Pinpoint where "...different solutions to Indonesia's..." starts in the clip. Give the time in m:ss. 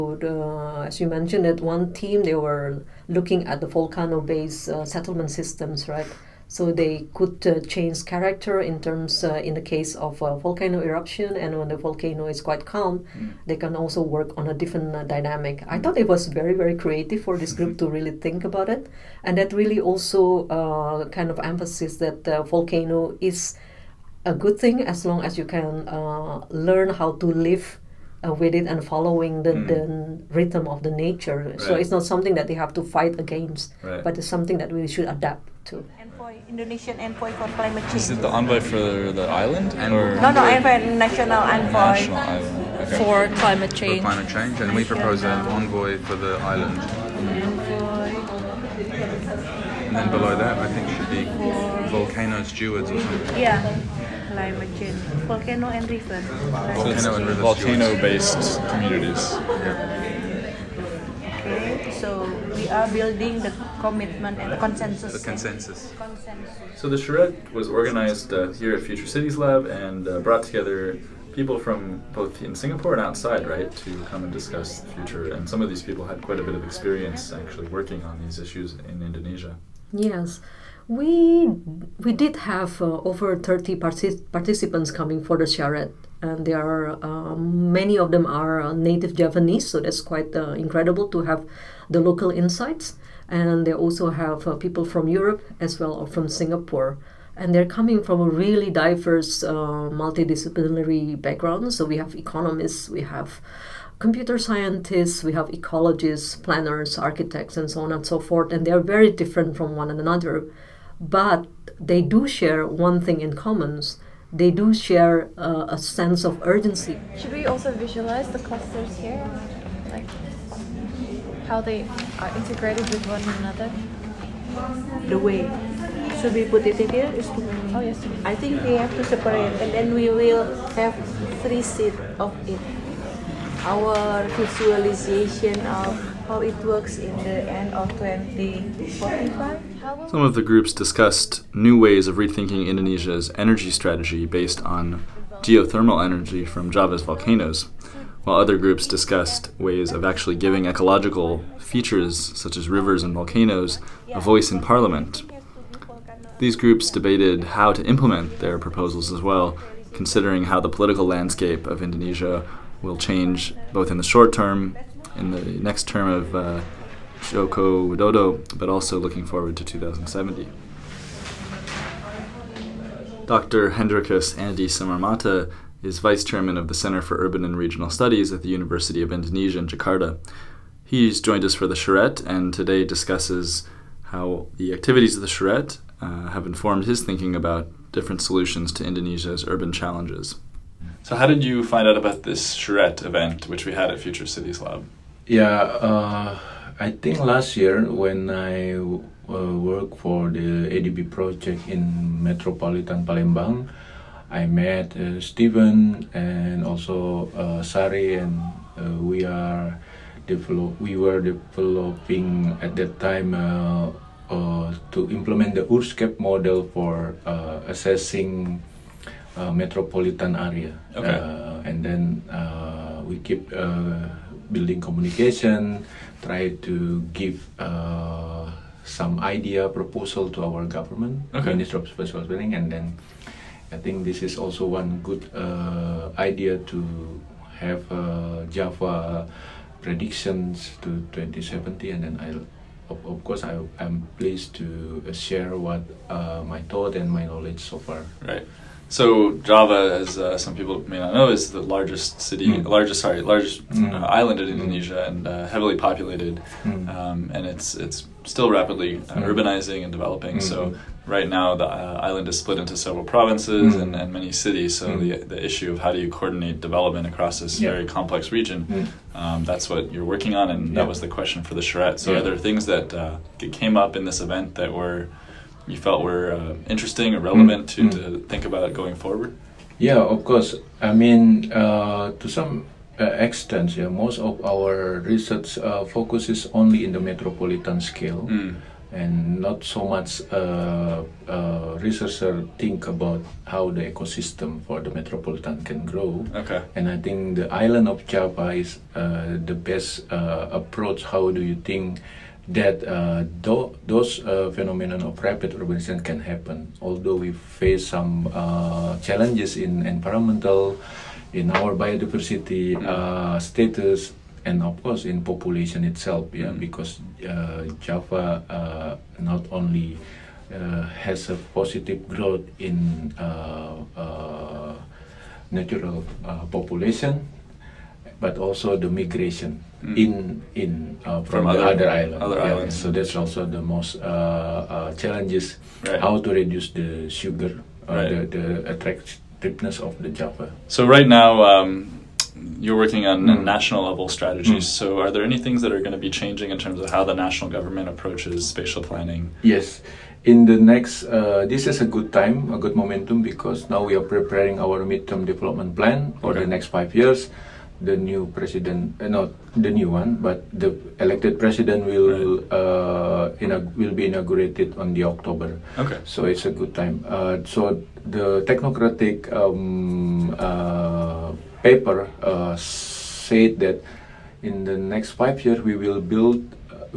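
3:07.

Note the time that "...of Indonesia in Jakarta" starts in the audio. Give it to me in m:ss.
2:59.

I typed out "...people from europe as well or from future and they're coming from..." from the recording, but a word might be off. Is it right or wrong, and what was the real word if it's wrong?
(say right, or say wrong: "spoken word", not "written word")
wrong: "singapore", not "future".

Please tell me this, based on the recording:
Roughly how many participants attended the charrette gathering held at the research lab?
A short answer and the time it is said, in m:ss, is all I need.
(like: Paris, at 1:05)
over 30, at 1:23.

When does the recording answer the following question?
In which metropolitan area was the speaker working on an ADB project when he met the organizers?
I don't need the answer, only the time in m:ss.
3:22.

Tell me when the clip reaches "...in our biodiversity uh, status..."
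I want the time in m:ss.
5:11.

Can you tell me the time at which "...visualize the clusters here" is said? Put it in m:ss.
1:57.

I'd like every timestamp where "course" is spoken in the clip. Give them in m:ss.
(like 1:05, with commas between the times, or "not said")
4:03, 4:40, 5:14.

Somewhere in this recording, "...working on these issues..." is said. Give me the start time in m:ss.
1:17.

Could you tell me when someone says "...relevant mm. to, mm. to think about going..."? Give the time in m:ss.
4:37.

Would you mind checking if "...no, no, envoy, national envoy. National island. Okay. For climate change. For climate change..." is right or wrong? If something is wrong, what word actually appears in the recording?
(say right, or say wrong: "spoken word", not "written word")
right.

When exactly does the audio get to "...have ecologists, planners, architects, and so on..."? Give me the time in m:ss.
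1:45.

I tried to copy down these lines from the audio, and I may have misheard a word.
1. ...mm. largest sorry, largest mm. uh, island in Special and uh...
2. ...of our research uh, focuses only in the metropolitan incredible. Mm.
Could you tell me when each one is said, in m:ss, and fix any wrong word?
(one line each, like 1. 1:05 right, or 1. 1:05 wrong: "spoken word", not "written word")
1. 4:12 wrong: "Indonesia", not "Special"
2. 4:44 wrong: "scale", not "incredible".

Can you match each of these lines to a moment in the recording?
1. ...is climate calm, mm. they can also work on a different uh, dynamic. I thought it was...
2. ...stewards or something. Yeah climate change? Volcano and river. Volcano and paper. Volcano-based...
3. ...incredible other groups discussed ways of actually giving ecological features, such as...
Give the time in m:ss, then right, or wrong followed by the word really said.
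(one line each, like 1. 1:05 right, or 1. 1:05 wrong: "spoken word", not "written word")
1. 0:12 wrong: "quite", not "climate"
2. 0:52 wrong: "river", not "paper"
3. 2:28 wrong: "while", not "incredible".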